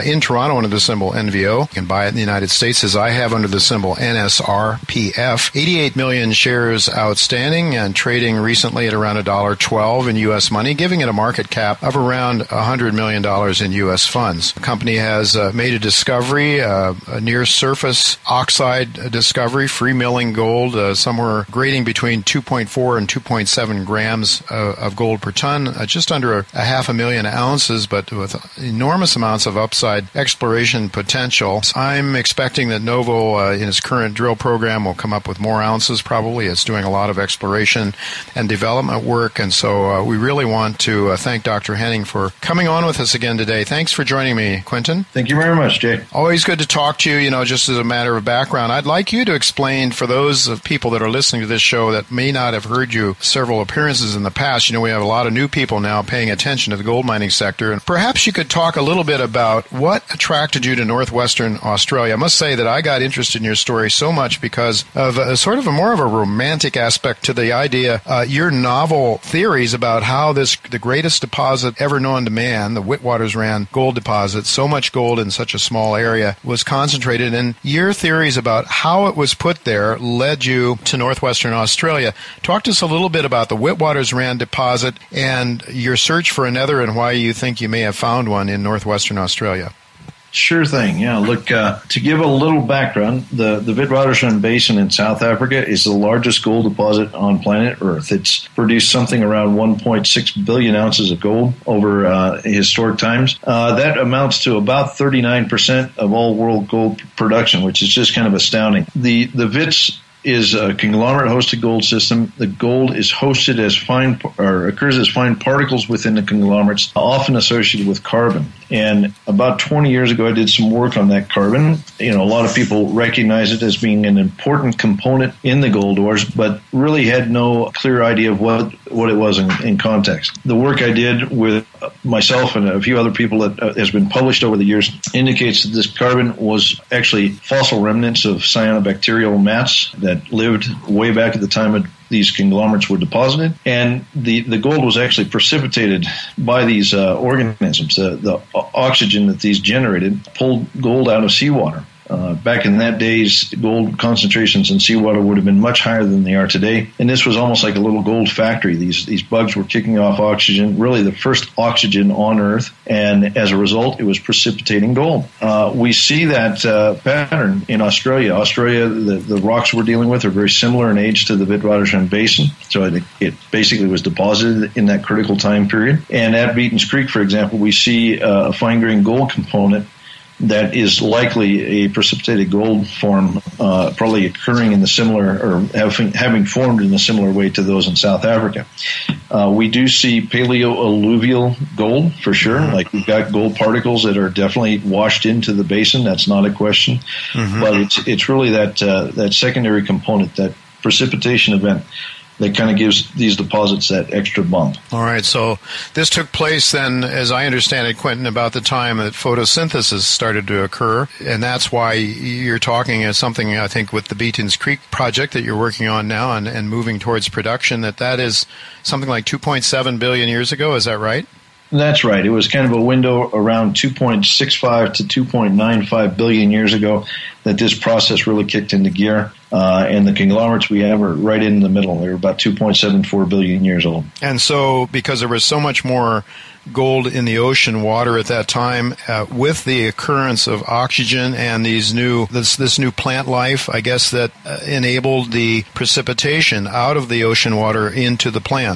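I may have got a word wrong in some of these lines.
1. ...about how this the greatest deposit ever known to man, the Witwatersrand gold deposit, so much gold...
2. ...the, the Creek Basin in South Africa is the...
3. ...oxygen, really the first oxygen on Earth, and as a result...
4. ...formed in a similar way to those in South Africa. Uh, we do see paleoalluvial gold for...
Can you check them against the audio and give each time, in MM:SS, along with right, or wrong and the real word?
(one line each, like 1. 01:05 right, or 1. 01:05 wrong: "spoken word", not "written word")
1. 01:09 right
2. 01:33 wrong: "Witwatersrand", not "Creek"
3. 02:40 right
4. 03:06 right.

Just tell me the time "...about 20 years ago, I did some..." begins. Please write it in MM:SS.
01:59.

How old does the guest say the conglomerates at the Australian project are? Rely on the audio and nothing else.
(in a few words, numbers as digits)
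2.74 billion years.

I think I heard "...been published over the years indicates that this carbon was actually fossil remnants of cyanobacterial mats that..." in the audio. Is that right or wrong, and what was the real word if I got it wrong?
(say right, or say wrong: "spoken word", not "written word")
right.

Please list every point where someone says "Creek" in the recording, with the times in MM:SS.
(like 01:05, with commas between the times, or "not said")
02:56, 03:34.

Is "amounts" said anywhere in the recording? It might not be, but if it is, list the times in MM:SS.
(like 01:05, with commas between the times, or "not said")
00:29, 01:43.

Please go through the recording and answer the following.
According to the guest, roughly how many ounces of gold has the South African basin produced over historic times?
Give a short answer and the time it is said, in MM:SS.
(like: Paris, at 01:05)
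1.6 billion ounces, at 01:39.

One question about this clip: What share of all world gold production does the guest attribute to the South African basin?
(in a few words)
39%.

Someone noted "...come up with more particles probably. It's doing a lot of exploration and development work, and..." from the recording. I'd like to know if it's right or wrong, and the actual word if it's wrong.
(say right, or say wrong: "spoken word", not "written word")
wrong: "ounces", not "particles".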